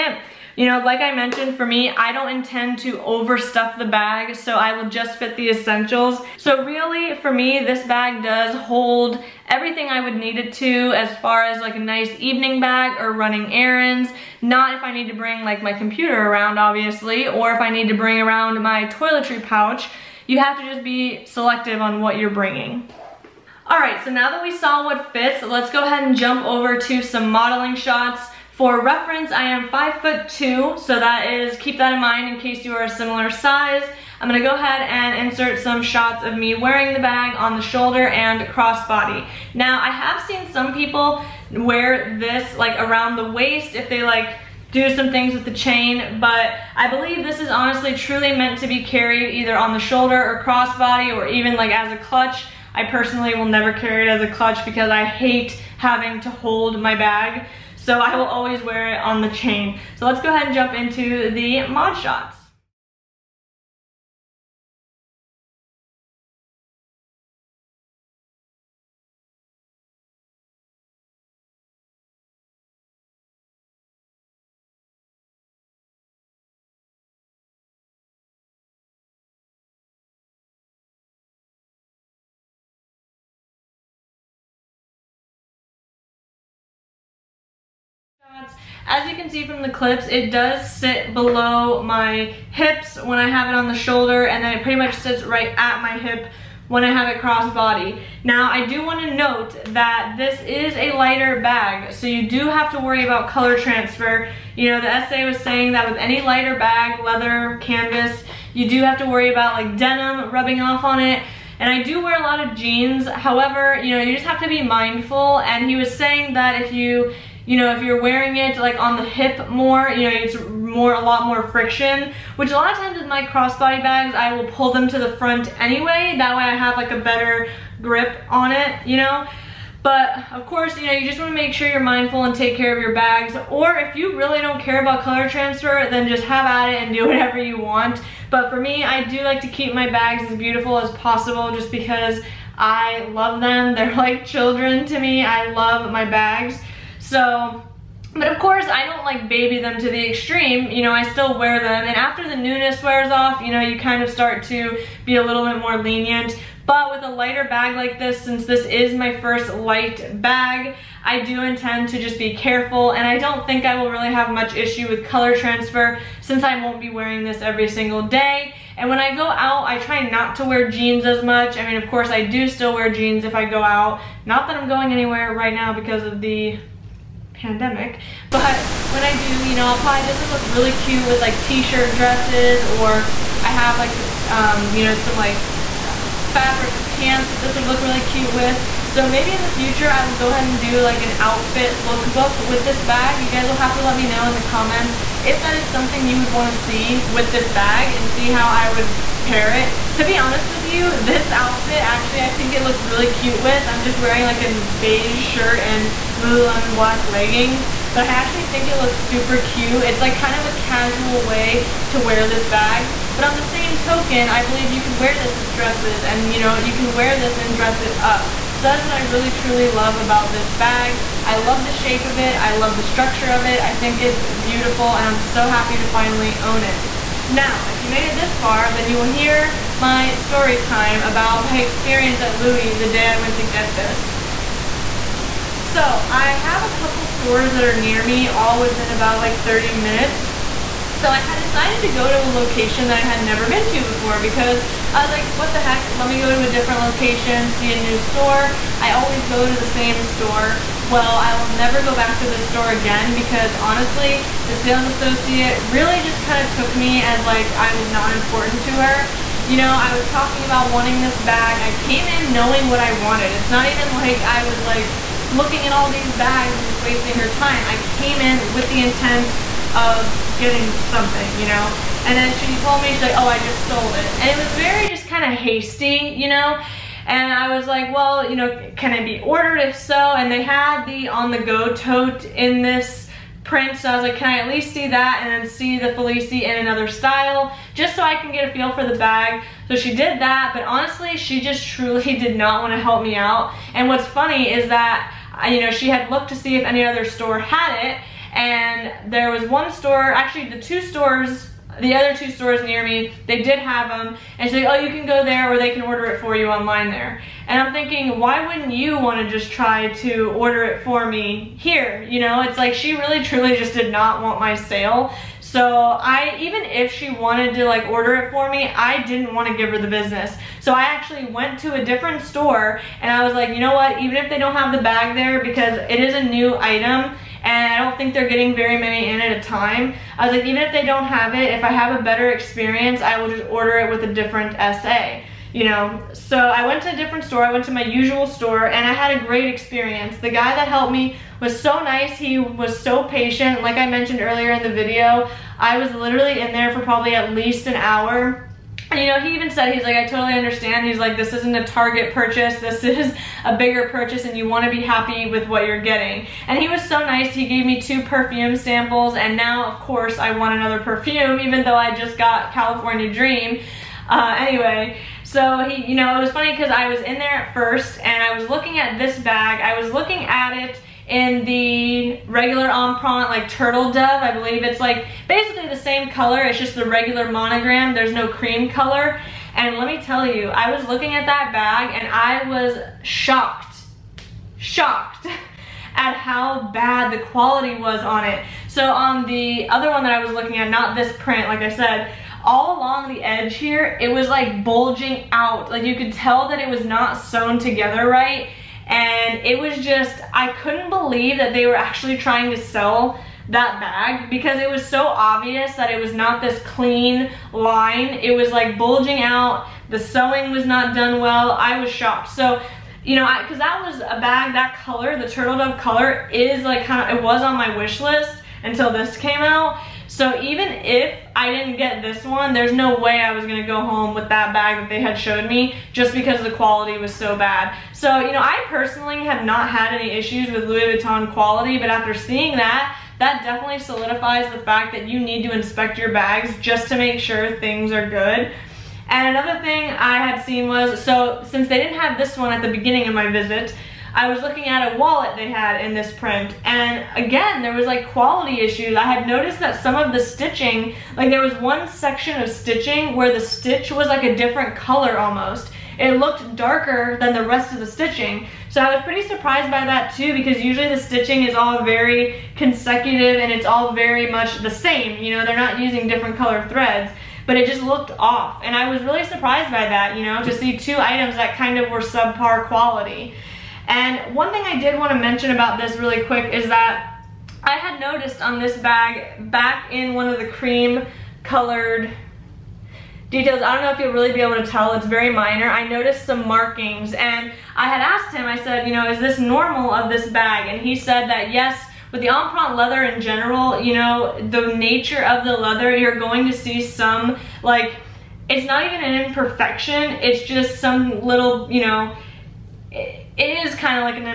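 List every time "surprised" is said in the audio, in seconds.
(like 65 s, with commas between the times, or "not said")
459 s, 469 s.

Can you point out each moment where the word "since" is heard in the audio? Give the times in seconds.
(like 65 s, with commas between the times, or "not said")
158 s, 166 s, 441 s.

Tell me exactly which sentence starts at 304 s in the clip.
And she's like, oh, you can go there or they can order it for you online there.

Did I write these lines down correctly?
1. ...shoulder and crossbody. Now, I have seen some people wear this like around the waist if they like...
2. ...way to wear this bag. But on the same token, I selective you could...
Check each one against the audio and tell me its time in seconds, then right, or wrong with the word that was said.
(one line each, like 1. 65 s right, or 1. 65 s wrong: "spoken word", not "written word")
1. 37 s right
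2. 211 s wrong: "believe", not "selective".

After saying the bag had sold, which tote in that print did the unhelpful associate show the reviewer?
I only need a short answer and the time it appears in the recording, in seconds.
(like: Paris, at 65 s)
On-the-go tote, at 281 s.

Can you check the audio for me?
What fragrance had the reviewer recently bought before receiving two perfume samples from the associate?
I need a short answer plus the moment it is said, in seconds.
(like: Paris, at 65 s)
California Dream, at 362 s.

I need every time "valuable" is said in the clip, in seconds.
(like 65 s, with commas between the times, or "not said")
not said.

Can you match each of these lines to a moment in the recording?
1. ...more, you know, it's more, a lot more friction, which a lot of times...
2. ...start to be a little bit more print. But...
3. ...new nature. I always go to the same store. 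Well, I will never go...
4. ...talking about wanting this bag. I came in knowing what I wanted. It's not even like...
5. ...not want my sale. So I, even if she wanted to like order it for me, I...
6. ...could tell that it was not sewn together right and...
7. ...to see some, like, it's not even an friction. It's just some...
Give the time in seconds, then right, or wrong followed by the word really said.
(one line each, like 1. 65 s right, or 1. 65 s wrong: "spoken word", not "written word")
1. 119 s right
2. 154 s wrong: "lenient", not "print"
3. 247 s wrong: "store", not "nature"
4. 260 s right
5. 313 s right
6. 395 s right
7. 496 s wrong: "imperfection", not "friction".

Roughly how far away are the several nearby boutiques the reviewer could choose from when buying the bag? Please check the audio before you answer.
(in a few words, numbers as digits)
30 minutes.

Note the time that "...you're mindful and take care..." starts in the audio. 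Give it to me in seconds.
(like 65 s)
131 s.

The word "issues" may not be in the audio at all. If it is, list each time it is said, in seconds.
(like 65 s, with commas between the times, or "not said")
164 s, 430 s, 448 s.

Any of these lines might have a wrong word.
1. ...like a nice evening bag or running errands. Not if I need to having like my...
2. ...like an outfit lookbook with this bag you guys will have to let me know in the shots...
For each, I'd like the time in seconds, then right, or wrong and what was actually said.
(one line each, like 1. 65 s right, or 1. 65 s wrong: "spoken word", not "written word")
1. 11 s wrong: "bring", not "having"
2. 190 s wrong: "comments", not "shots".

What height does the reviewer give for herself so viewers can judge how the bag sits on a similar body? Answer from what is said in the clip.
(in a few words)
5 foot 2.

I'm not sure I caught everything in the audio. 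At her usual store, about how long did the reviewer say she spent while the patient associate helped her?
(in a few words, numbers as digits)
at least an hour.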